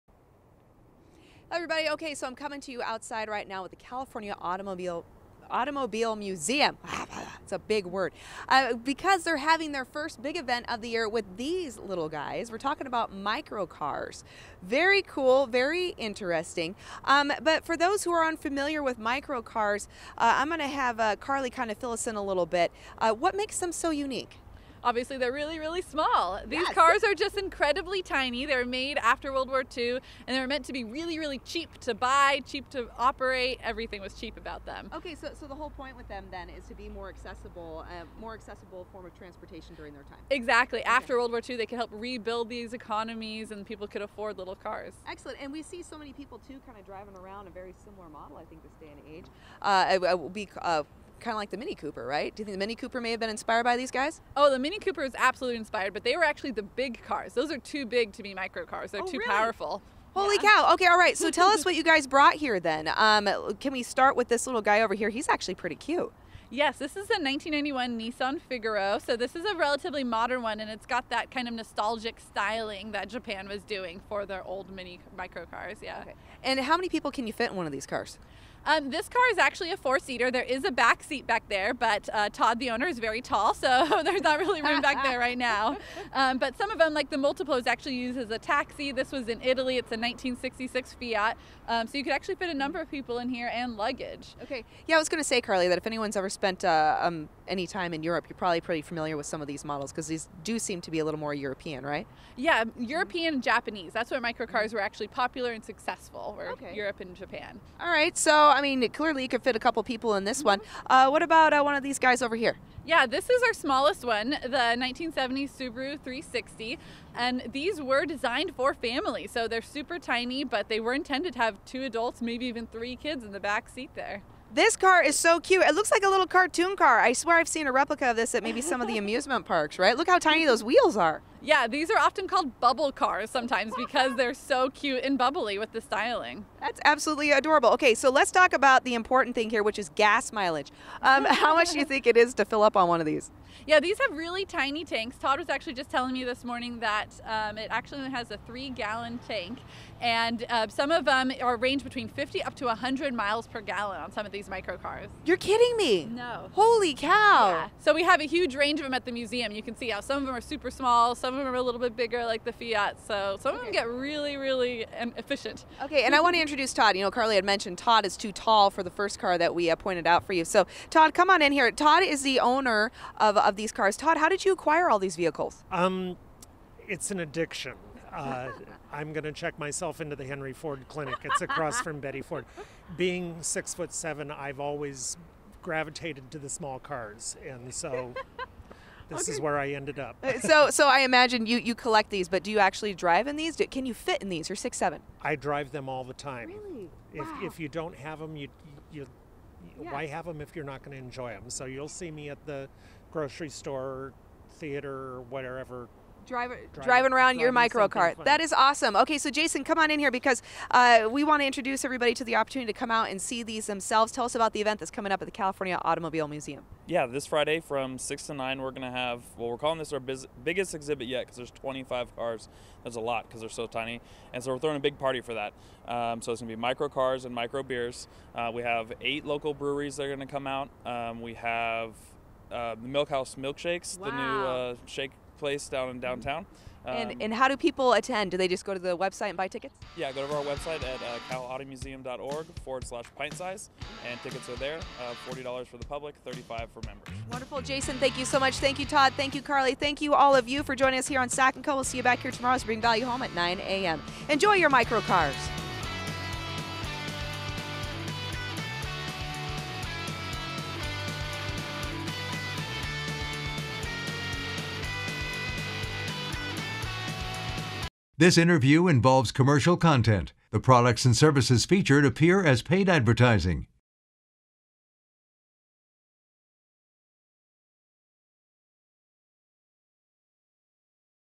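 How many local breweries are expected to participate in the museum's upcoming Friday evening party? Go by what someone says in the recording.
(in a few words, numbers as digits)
8.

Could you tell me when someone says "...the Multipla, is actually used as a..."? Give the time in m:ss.
1:27.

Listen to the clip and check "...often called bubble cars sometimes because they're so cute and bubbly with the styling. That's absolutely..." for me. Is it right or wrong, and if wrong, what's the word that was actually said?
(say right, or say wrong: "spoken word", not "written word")
right.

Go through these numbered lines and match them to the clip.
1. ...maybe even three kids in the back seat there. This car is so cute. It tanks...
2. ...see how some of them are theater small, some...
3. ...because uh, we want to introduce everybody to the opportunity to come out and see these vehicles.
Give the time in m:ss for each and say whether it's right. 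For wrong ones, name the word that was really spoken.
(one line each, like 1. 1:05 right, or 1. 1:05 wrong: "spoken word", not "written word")
1. 2:02 wrong: "looks", not "tanks"
2. 2:39 wrong: "super", not "theater"
3. 3:30 wrong: "themselves", not "vehicles".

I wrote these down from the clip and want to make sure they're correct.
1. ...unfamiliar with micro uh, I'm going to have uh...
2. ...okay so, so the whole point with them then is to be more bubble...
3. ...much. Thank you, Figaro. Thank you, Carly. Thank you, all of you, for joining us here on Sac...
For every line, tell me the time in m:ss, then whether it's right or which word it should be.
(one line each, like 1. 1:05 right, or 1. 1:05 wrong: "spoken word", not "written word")
1. 0:18 right
2. 0:34 wrong: "accessible", not "bubble"
3. 4:08 wrong: "Todd", not "Figaro".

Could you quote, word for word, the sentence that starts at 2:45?
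Okay, and I want to introduce Todd.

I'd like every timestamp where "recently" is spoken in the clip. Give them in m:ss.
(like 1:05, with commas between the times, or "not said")
not said.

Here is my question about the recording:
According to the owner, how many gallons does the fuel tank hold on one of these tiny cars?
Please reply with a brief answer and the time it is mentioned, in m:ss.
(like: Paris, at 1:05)
3, at 2:28.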